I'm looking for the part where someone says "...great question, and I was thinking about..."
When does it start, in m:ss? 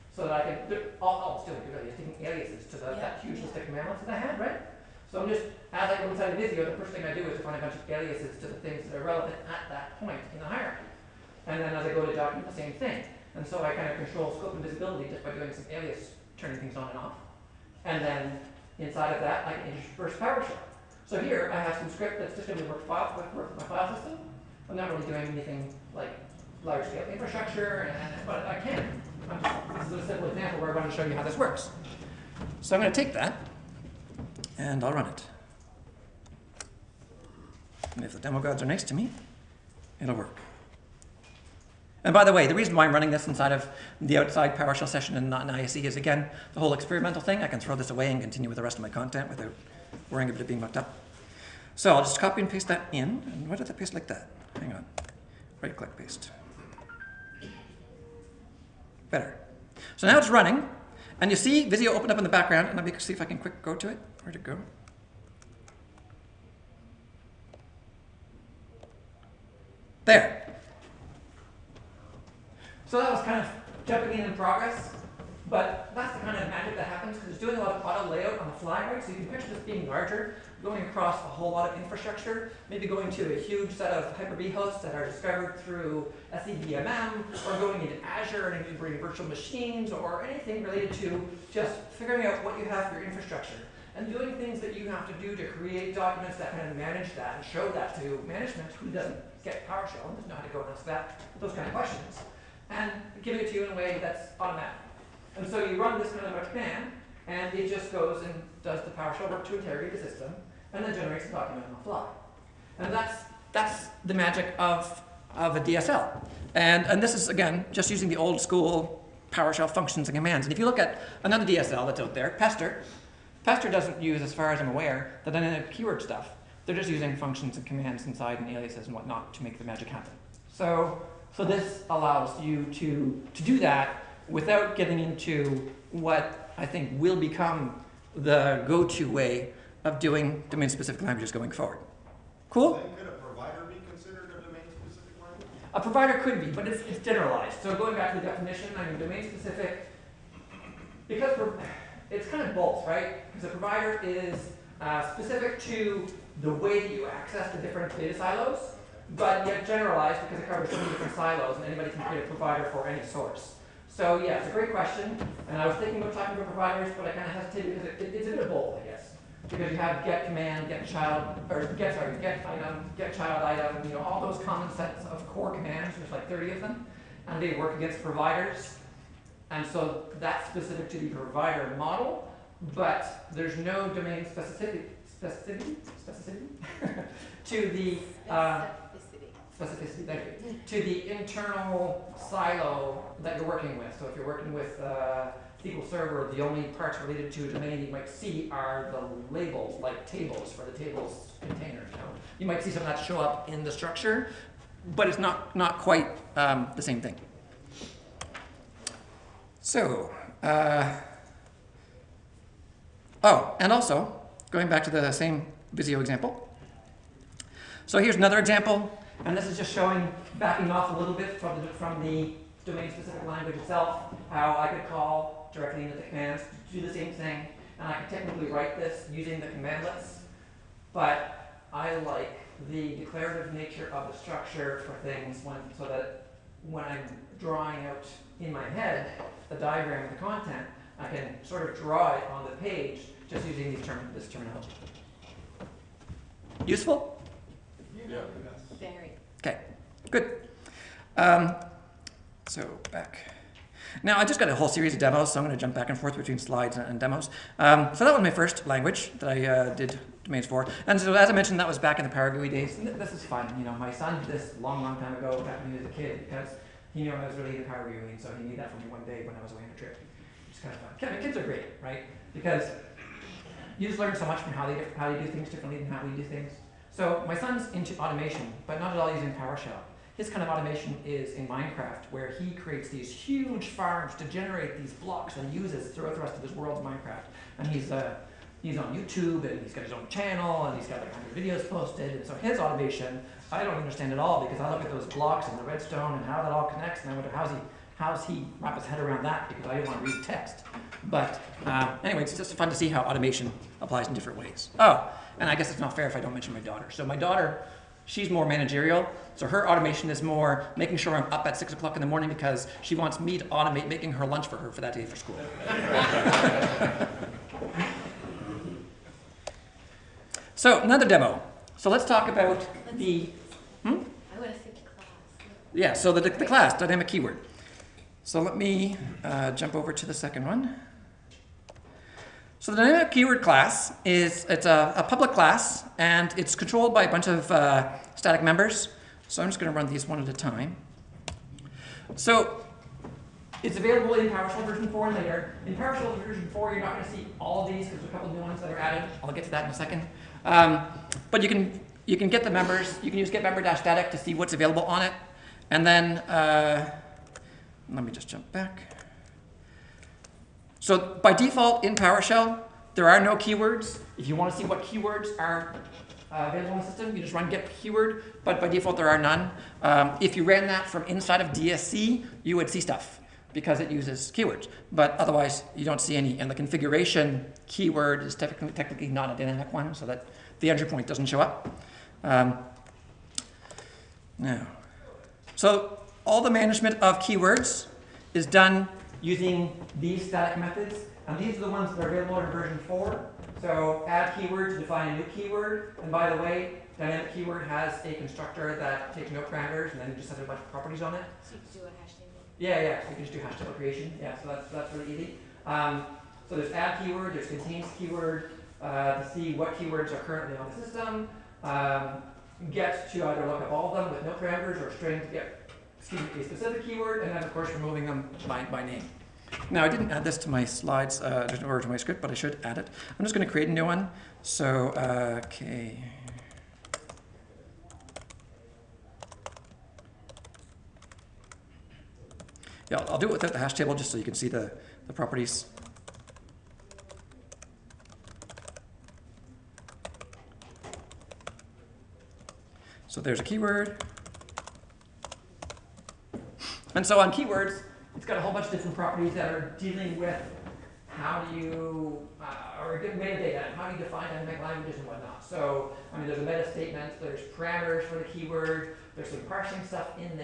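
2:44.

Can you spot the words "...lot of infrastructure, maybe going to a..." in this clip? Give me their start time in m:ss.
1:21.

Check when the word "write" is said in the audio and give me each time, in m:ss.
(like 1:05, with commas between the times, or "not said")
3:48.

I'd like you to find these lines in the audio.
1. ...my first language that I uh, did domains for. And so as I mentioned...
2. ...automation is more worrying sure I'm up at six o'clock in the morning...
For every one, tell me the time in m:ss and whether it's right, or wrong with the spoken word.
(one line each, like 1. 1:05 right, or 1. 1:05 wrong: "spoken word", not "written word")
1. 4:18 right
2. 5:09 wrong: "making", not "worrying".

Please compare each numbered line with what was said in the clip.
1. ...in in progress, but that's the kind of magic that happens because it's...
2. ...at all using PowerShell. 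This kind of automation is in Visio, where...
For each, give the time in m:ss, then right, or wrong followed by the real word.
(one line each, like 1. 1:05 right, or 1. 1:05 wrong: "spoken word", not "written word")
1. 1:14 right
2. 4:38 wrong: "Minecraft", not "Visio".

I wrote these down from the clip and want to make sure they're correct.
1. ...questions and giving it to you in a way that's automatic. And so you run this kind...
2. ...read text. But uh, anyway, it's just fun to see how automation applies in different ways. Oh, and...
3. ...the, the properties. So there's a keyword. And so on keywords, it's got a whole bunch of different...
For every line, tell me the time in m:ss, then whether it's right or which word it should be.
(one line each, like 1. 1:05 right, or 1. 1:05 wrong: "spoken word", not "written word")
1. 1:41 right
2. 5:00 right
3. 7:14 right.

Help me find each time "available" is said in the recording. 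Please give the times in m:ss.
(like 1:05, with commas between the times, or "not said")
5:43, 5:54, 6:06, 6:32.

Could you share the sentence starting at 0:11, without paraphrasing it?
And then as I go to document, the same thing.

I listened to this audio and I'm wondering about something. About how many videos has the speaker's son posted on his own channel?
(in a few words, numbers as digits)
100.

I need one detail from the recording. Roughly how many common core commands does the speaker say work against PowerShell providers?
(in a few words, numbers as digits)
30.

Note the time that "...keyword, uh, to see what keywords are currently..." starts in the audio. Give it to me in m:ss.
6:47.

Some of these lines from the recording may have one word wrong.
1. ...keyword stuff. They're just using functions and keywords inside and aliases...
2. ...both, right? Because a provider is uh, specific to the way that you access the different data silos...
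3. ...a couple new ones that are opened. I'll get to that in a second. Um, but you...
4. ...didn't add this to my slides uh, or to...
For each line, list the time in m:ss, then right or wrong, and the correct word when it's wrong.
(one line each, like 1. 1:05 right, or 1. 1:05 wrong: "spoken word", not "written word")
1. 2:05 wrong: "commands", not "keywords"
2. 2:32 right
3. 5:48 wrong: "added", not "opened"
4. 6:59 right.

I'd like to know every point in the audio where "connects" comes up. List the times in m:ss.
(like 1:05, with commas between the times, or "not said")
4:56.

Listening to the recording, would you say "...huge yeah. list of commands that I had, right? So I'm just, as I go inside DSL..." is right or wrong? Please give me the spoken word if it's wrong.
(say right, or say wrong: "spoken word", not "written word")
wrong: "Visio", not "DSL".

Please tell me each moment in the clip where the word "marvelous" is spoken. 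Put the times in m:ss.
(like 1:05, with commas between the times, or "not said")
not said.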